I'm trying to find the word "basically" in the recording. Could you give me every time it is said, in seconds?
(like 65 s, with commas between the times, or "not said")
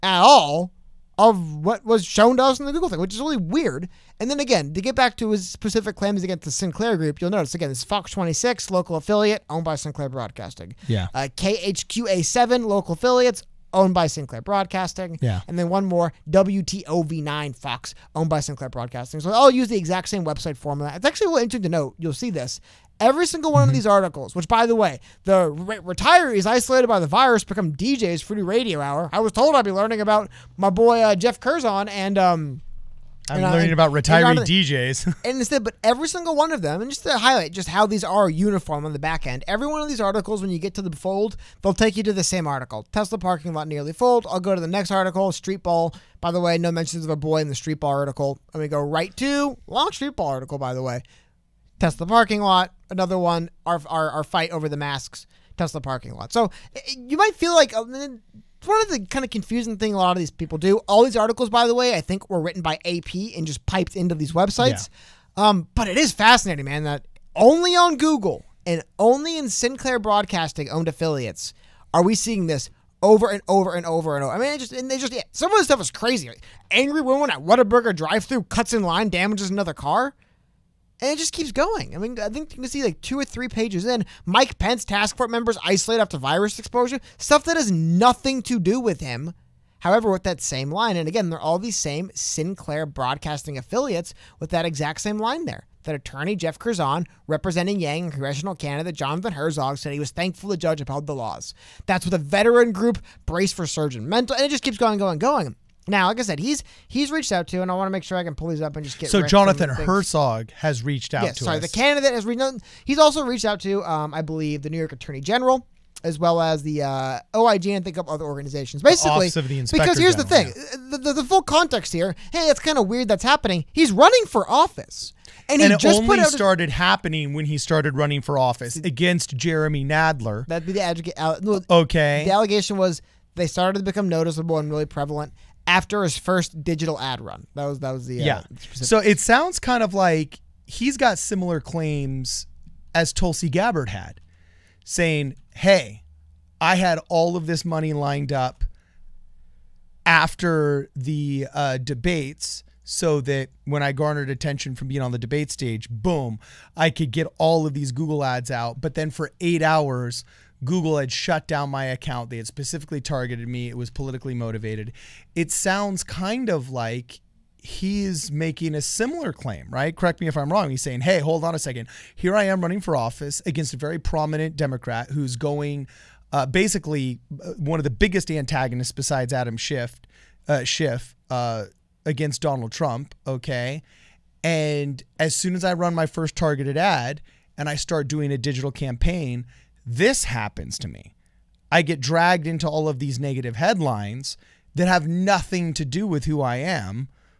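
118 s, 176 s.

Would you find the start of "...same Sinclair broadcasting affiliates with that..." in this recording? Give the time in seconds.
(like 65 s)
91 s.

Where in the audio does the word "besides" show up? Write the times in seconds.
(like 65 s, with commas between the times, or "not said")
178 s.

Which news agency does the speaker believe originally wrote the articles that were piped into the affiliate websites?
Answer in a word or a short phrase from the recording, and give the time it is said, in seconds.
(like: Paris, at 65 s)
AP, at 62 s.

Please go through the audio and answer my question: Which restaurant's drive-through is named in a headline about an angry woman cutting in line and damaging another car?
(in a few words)
Whataburger.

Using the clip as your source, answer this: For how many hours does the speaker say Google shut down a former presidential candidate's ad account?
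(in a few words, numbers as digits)
8.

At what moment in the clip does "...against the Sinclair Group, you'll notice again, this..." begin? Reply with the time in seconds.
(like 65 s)
6 s.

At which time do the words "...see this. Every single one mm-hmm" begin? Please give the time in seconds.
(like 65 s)
22 s.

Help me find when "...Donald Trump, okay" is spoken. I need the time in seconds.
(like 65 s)
182 s.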